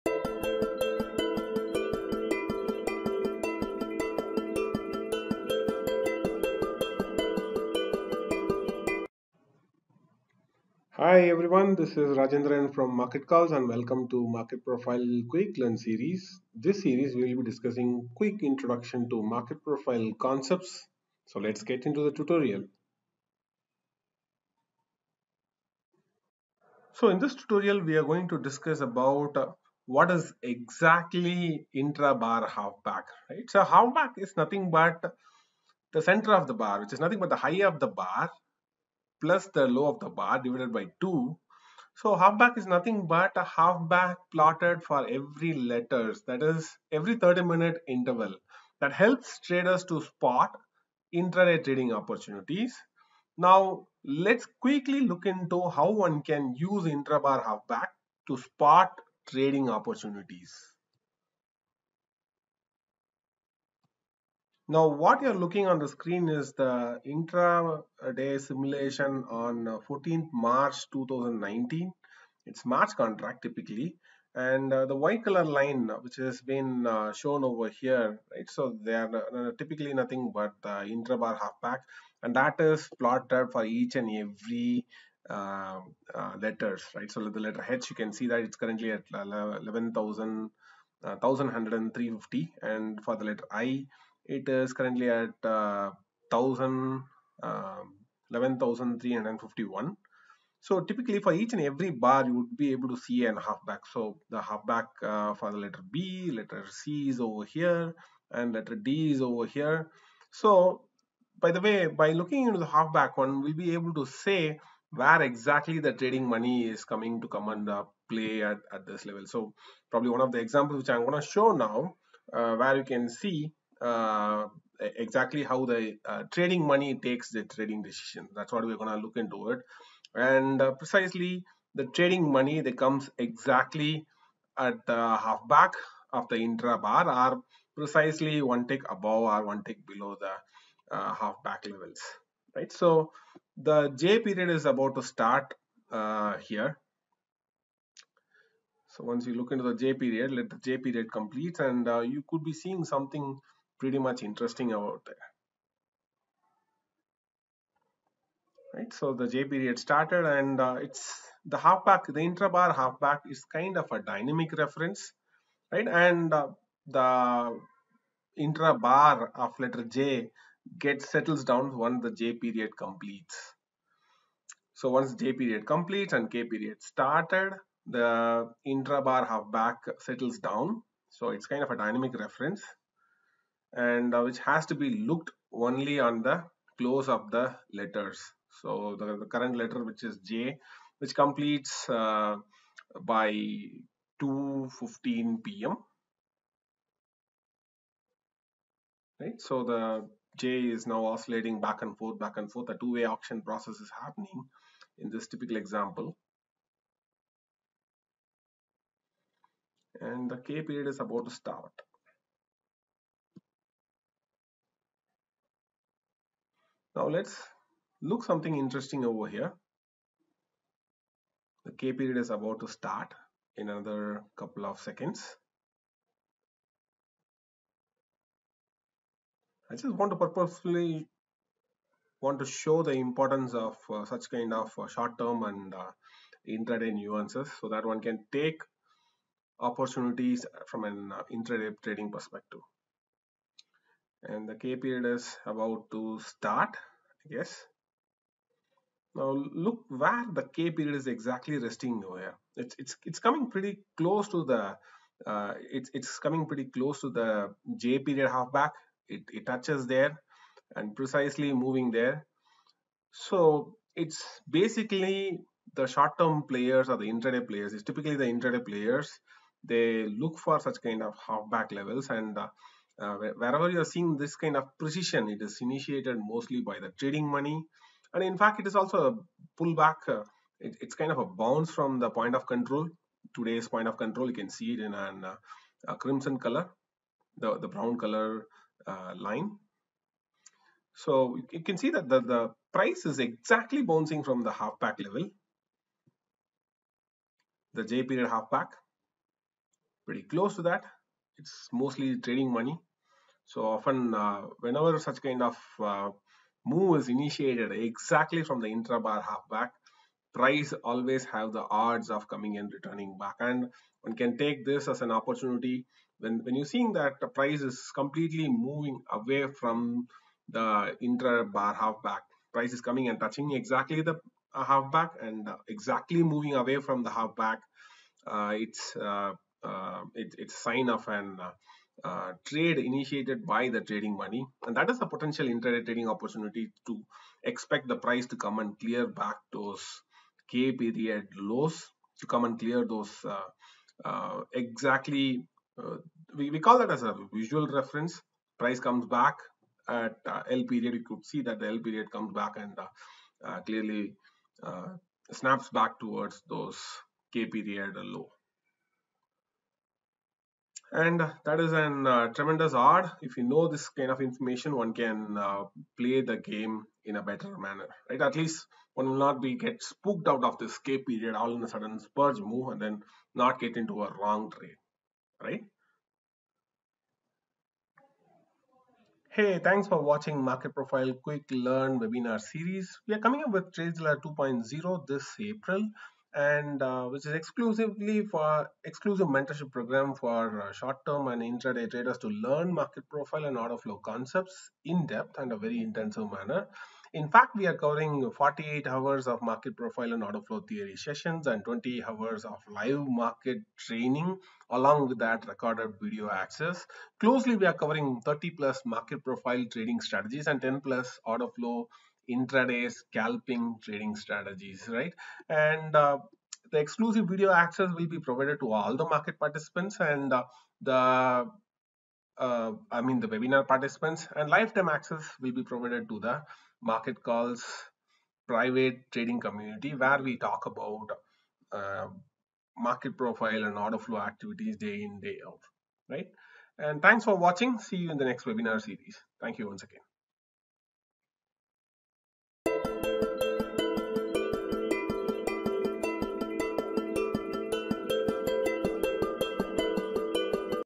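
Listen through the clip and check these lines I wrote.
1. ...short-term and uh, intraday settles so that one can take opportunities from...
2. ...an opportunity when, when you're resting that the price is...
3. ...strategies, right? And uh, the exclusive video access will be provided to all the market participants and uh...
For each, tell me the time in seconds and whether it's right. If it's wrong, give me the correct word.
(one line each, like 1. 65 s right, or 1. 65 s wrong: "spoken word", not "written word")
1. 234 s wrong: "nuances", not "settles"
2. 315 s wrong: "seeing", not "resting"
3. 414 s right.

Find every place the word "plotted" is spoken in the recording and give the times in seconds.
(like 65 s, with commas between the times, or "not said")
44 s, 82 s.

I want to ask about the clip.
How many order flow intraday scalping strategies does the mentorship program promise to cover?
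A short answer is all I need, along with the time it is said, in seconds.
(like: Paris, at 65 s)
10 plus, at 410 s.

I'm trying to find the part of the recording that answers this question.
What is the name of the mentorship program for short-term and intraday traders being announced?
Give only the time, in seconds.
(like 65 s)
383 s.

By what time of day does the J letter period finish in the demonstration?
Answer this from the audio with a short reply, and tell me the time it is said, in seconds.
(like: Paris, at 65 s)
2:15 p.m., at 194 s.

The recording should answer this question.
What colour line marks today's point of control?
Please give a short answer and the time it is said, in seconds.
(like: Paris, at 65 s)
Crimson, at 285 s.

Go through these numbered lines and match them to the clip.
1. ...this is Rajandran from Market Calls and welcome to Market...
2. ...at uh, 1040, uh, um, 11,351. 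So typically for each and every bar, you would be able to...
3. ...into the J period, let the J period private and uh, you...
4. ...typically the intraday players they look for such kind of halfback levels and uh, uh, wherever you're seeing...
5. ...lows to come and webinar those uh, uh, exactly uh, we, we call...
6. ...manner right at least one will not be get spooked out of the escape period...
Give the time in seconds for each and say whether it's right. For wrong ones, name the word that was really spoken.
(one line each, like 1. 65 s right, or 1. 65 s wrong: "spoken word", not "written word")
1. 11 s right
2. 95 s wrong: "1000", not "1040"
3. 149 s wrong: "complete", not "private"
4. 267 s right
5. 341 s wrong: "clear", not "webinar"
6. 367 s right.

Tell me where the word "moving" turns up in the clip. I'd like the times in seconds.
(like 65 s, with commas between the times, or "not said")
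261 s, 318 s, 326 s.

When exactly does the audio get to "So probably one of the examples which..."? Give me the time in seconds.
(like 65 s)
119 s.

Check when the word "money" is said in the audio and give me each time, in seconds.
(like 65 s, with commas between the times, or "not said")
116 s, 126 s, 132 s, 277 s, 302 s, 334 s.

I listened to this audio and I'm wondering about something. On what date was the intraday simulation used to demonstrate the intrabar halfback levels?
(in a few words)
14th March 2019.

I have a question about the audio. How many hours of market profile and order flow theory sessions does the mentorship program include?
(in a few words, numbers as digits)
48 hours.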